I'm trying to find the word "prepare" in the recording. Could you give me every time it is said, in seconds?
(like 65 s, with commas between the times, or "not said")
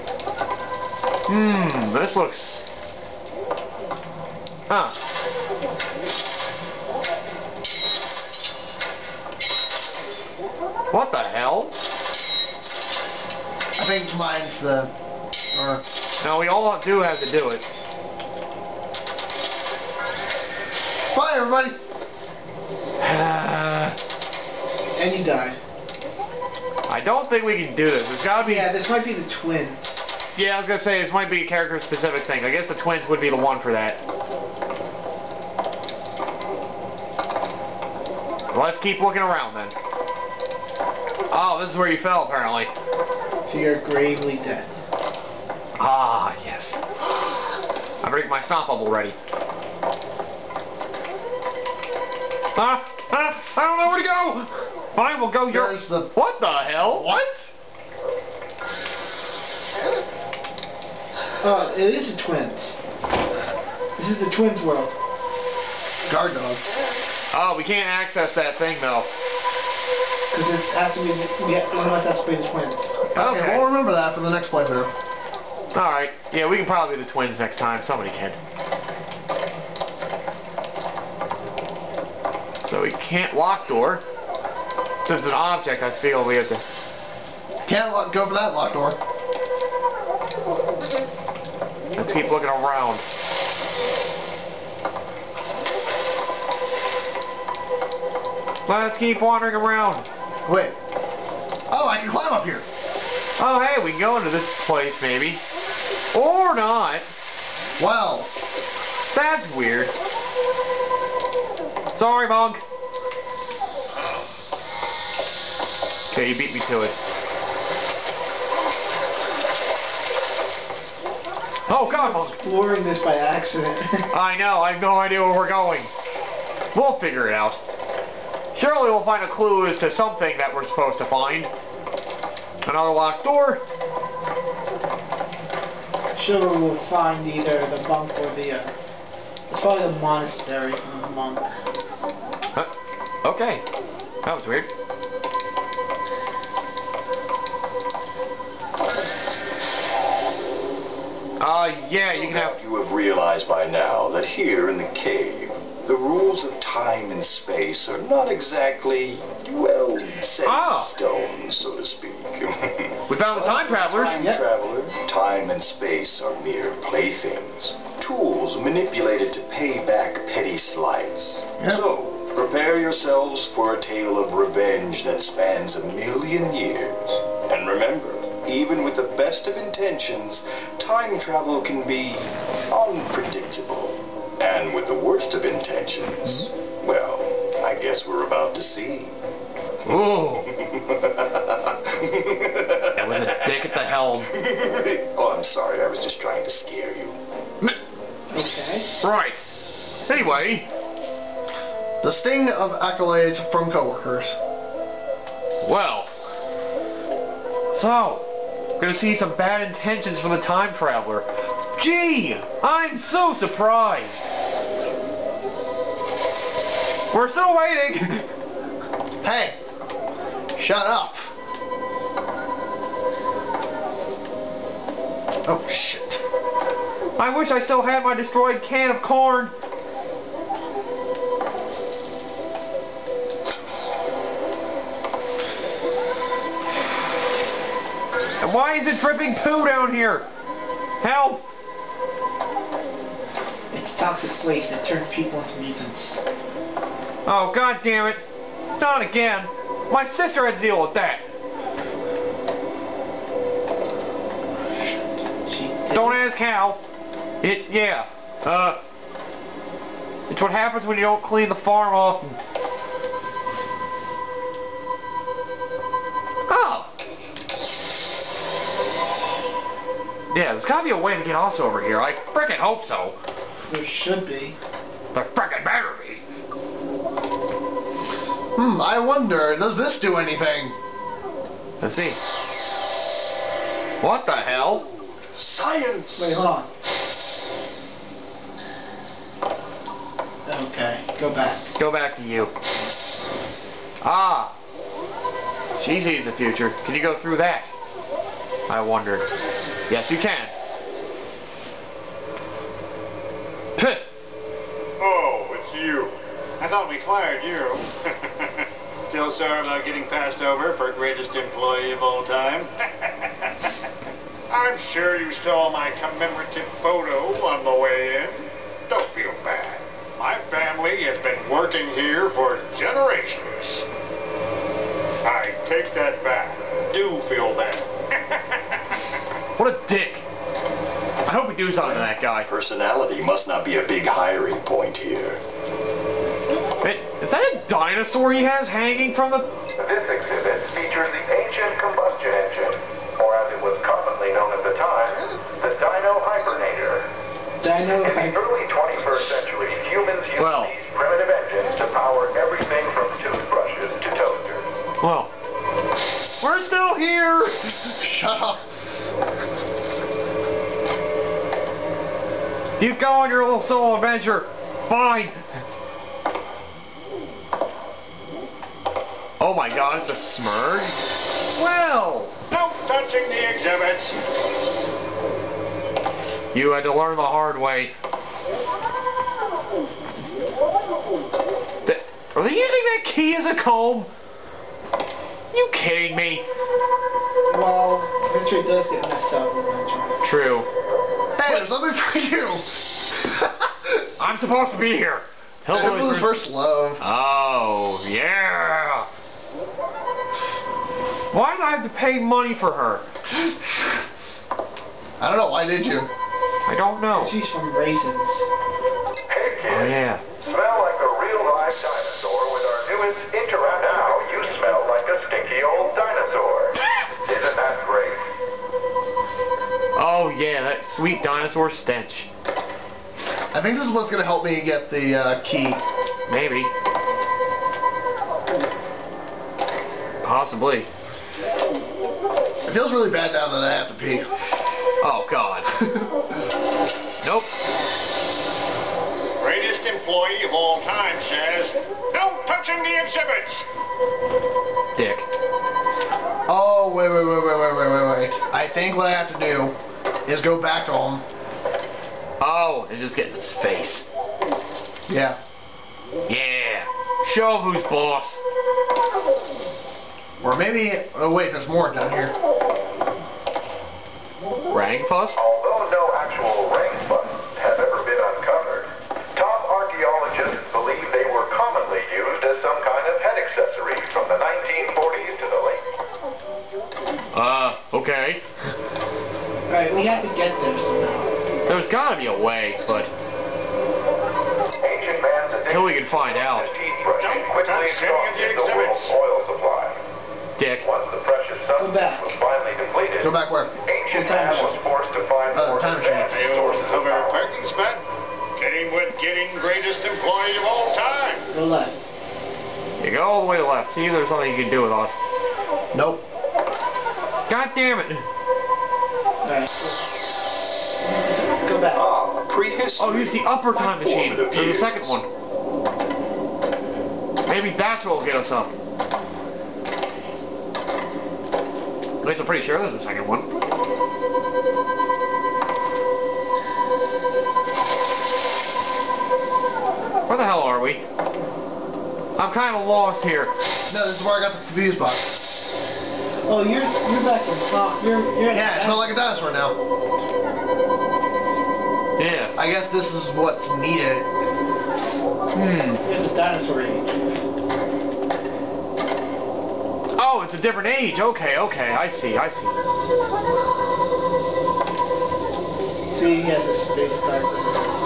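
172 s.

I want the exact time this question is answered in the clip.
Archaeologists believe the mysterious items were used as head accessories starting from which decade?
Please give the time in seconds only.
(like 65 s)
474 s.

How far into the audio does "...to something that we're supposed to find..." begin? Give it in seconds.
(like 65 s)
129 s.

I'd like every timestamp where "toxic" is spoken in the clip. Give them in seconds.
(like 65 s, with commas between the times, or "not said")
243 s.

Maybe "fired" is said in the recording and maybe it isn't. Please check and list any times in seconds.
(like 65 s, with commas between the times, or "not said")
306 s.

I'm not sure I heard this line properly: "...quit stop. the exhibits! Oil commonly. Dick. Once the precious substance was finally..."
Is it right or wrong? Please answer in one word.
wrong.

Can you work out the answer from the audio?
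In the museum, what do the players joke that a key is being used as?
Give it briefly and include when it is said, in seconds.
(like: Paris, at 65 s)
A comb, at 383 s.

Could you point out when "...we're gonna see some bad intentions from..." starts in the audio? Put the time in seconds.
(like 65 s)
208 s.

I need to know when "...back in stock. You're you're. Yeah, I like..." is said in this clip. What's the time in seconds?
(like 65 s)
537 s.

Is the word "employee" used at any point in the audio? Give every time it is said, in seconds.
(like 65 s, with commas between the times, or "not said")
311 s, 439 s, 500 s.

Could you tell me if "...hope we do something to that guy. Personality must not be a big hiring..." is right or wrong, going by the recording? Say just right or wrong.
right.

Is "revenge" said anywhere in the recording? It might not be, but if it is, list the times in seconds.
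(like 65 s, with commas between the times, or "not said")
174 s.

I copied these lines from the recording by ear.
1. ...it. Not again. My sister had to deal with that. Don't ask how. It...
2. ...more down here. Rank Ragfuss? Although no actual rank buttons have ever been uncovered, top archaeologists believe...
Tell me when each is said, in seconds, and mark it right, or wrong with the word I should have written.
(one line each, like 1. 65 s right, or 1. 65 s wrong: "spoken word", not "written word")
1. 248 s right
2. 461 s right.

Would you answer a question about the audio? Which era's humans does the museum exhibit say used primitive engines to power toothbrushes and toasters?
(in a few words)
Early 21st century.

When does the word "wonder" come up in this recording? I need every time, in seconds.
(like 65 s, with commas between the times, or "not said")
278 s, 298 s.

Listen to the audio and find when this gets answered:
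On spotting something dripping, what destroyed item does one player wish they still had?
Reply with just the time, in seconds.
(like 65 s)
228 s.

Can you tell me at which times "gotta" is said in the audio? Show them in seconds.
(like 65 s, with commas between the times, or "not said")
28 s, 270 s, 481 s.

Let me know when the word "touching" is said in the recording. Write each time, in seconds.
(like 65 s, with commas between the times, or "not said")
372 s, 442 s.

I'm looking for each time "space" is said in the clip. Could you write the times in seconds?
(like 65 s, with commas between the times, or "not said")
157 s, 165 s, 556 s.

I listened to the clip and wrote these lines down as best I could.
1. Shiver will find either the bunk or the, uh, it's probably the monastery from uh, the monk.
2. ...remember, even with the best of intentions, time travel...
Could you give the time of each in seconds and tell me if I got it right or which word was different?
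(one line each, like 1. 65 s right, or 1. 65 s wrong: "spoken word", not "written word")
1. 136 s right
2. 177 s right.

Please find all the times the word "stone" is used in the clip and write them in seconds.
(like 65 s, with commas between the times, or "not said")
160 s.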